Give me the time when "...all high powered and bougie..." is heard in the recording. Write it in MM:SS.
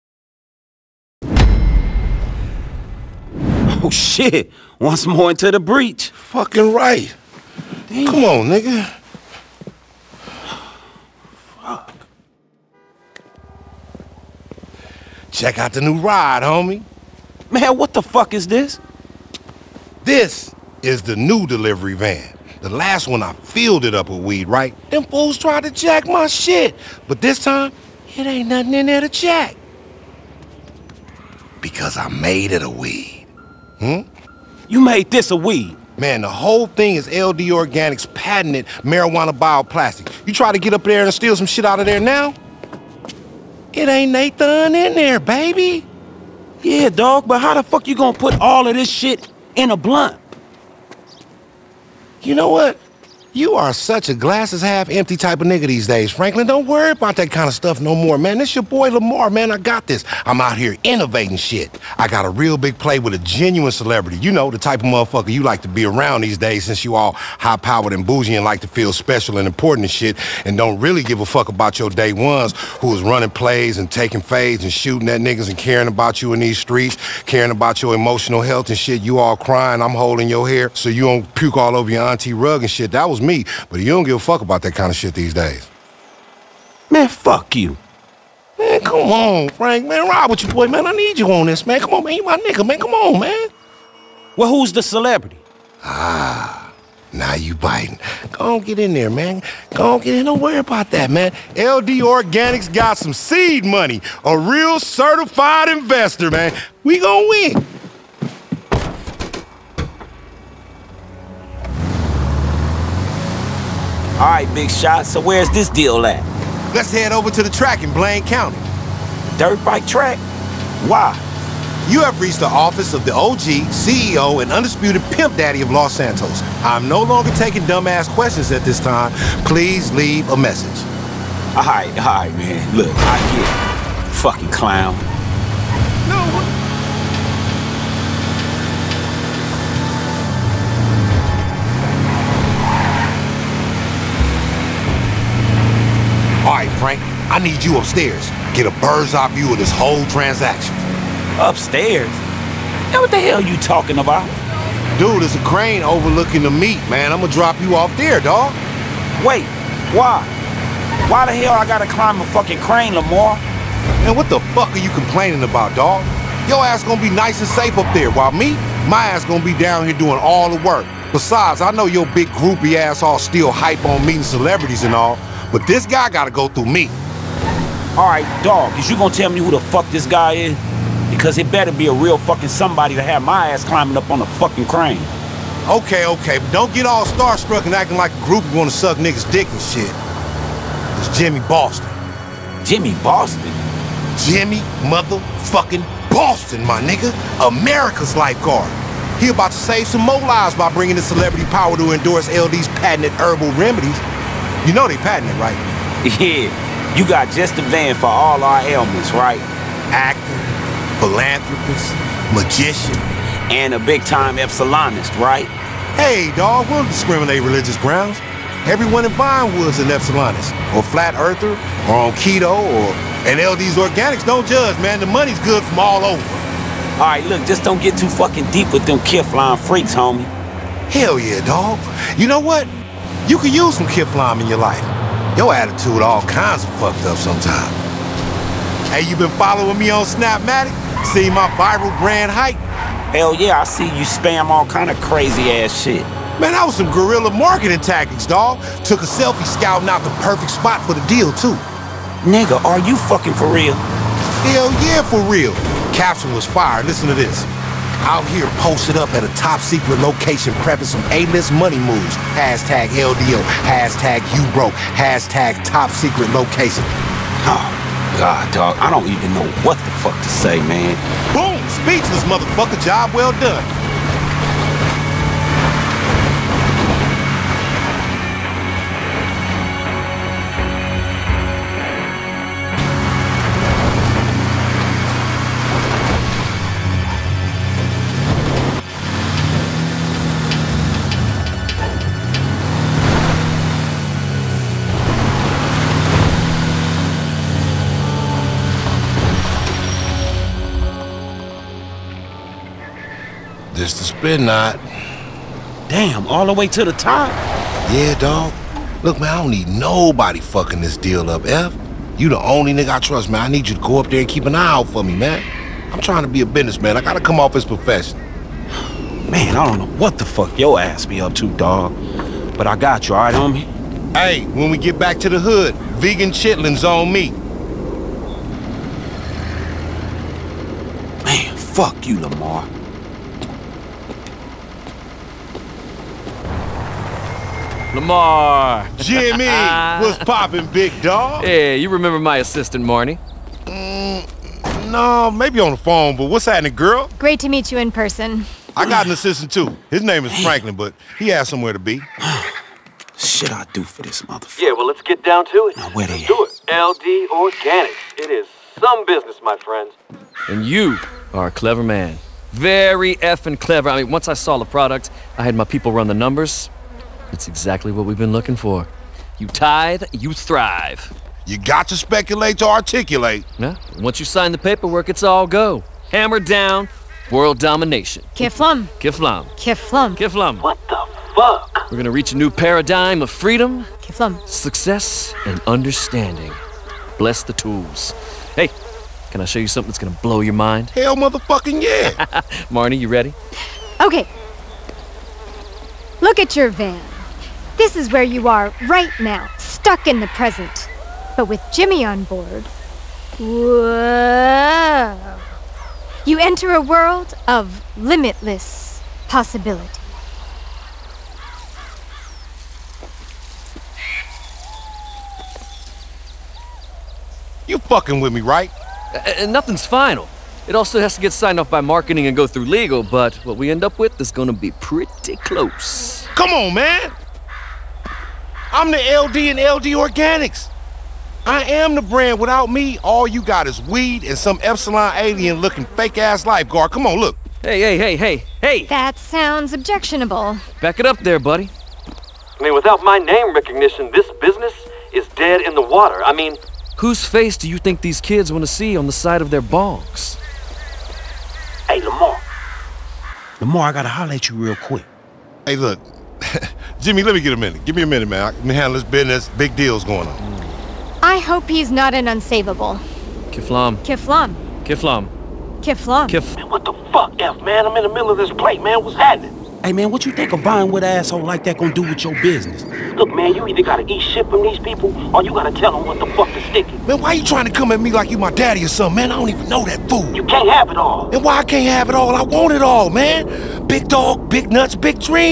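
01:06.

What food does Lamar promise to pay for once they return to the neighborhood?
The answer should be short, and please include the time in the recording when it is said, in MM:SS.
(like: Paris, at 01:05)
vegan chitlins, at 05:25.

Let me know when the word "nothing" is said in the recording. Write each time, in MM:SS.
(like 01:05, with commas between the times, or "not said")
00:28, 06:59.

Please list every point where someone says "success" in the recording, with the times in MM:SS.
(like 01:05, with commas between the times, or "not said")
06:24.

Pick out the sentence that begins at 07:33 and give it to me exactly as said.
Lamar, I gotta holler at you real quick.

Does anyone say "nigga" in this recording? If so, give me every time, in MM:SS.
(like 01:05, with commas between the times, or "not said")
00:08, 00:55, 01:15, 01:32, 03:08, 03:16, 04:12, 05:12.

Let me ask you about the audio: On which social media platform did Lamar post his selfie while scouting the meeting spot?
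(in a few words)
Snapmatic.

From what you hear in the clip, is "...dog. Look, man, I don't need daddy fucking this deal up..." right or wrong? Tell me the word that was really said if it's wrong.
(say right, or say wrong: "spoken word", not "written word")
wrong: "nobody", not "daddy".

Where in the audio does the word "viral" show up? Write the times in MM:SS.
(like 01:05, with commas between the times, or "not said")
04:01.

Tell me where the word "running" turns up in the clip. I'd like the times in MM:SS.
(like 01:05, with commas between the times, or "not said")
01:13.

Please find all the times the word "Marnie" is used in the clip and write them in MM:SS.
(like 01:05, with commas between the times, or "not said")
05:42, 06:32.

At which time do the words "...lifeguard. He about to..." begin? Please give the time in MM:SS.
03:18.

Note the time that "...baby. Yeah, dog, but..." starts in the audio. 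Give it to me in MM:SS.
00:45.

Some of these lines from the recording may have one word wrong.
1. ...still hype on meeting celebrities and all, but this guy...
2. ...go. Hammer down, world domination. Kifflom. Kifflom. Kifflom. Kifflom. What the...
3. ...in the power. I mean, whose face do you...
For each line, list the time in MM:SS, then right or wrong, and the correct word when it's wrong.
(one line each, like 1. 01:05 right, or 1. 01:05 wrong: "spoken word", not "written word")
1. 02:53 right
2. 06:15 right
3. 07:25 wrong: "water", not "power".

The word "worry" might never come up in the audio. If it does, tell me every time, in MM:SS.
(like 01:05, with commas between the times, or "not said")
00:56, 01:40.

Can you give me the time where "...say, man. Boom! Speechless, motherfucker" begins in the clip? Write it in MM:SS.
04:30.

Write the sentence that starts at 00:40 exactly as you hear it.
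You try to get up there and steal some shit out of there now?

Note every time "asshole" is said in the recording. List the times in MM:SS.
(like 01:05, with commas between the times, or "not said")
07:51.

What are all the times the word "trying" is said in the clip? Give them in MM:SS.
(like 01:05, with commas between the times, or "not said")
05:15, 07:57.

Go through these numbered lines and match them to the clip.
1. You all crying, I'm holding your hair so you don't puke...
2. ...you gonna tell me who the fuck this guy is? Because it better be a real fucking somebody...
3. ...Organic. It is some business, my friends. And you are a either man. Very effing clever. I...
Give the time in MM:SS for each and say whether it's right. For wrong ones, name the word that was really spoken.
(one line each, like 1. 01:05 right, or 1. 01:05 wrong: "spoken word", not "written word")
1. 01:19 right
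2. 02:58 right
3. 05:57 wrong: "clever", not "either".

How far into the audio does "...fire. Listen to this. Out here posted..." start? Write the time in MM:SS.
04:16.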